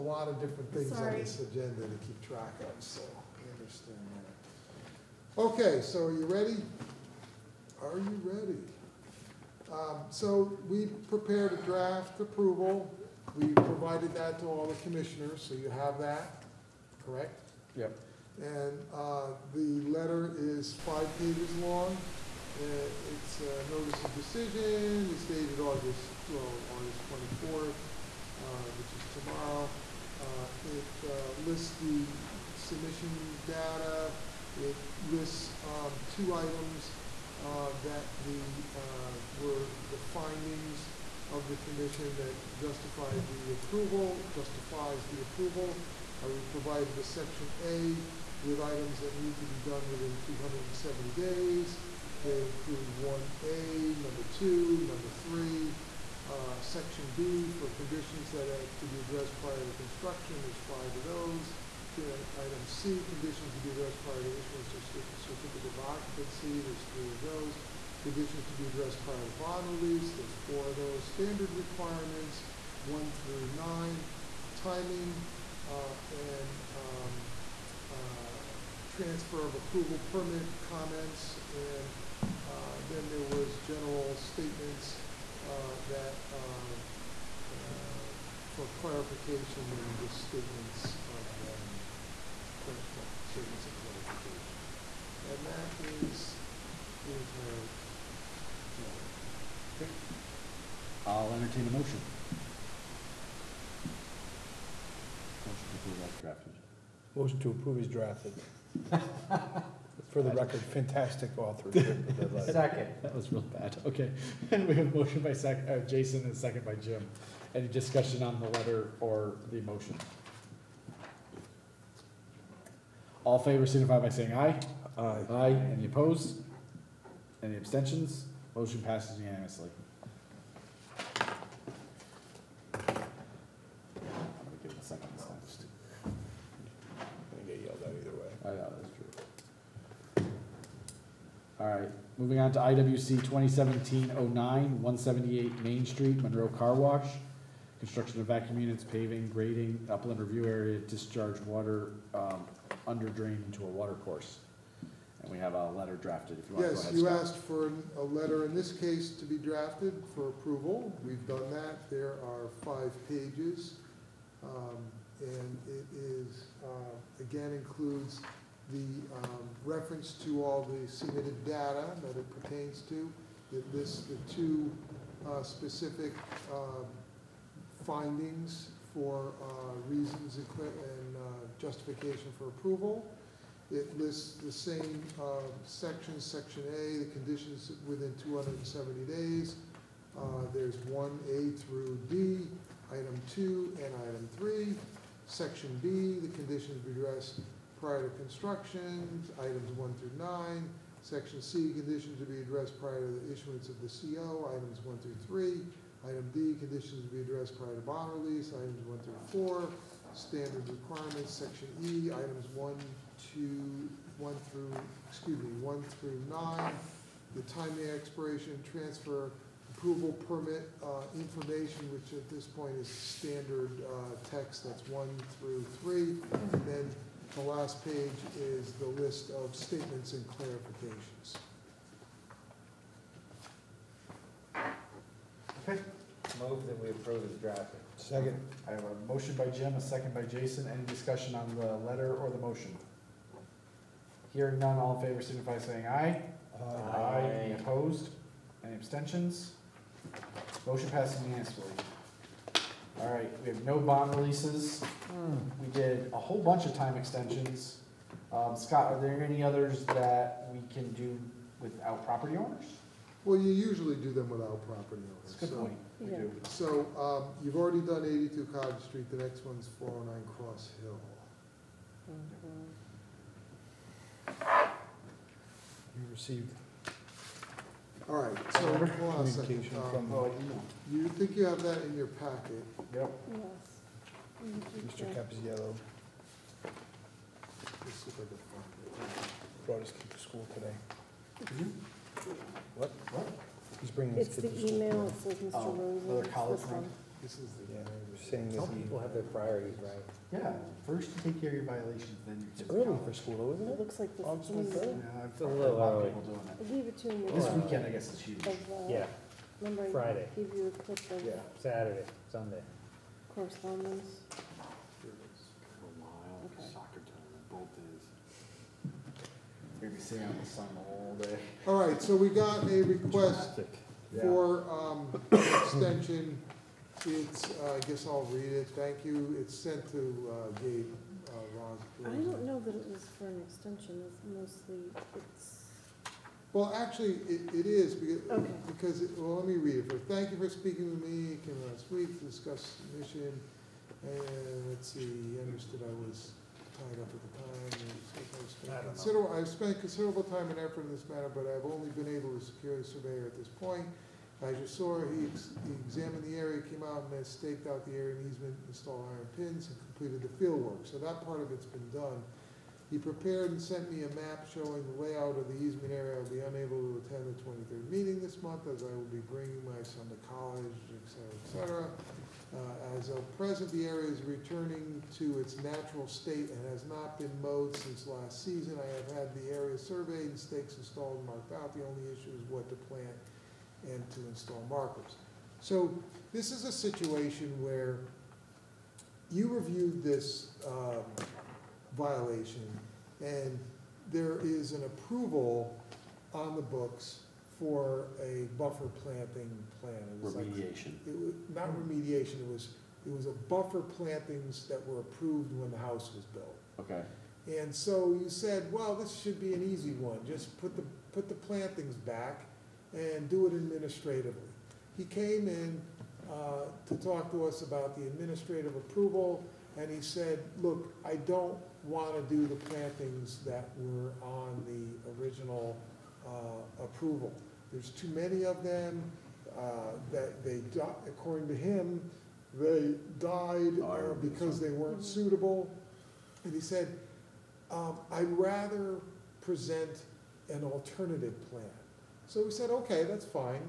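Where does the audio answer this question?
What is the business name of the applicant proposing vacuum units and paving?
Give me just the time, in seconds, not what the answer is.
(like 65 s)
146 s.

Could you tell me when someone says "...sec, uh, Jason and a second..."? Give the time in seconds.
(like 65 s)
115 s.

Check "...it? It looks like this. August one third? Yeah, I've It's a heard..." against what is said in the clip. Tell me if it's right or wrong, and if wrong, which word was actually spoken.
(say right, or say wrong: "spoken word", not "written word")
right.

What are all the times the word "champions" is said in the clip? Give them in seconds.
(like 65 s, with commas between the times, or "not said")
not said.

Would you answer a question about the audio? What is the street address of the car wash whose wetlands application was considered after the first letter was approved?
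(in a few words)
178 Main Street.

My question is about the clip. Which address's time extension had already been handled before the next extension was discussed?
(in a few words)
82 Cottage Street.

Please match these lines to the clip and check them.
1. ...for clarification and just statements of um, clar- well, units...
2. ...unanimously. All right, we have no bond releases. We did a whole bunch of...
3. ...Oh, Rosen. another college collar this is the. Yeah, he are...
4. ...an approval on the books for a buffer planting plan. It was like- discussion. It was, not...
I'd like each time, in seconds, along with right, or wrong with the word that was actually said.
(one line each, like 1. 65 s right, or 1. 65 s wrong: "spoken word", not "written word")
1. 88 s wrong: "statements", not "units"
2. 251 s right
3. 295 s right
4. 394 s wrong: "remediation", not "discussion".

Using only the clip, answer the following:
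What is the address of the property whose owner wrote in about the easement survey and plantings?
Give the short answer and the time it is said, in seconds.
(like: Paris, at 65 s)
409 Cross Hill, at 269 s.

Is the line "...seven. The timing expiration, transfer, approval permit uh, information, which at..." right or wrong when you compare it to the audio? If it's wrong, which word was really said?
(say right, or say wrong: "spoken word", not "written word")
wrong: "nine", not "seven".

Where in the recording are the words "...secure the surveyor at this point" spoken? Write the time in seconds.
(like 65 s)
352 s.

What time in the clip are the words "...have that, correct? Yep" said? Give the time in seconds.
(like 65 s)
15 s.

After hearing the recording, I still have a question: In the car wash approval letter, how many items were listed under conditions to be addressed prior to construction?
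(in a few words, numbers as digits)
9.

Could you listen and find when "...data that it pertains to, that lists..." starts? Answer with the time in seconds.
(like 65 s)
171 s.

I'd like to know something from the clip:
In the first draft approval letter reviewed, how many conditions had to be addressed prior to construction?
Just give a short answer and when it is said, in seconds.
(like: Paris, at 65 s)
5, at 60 s.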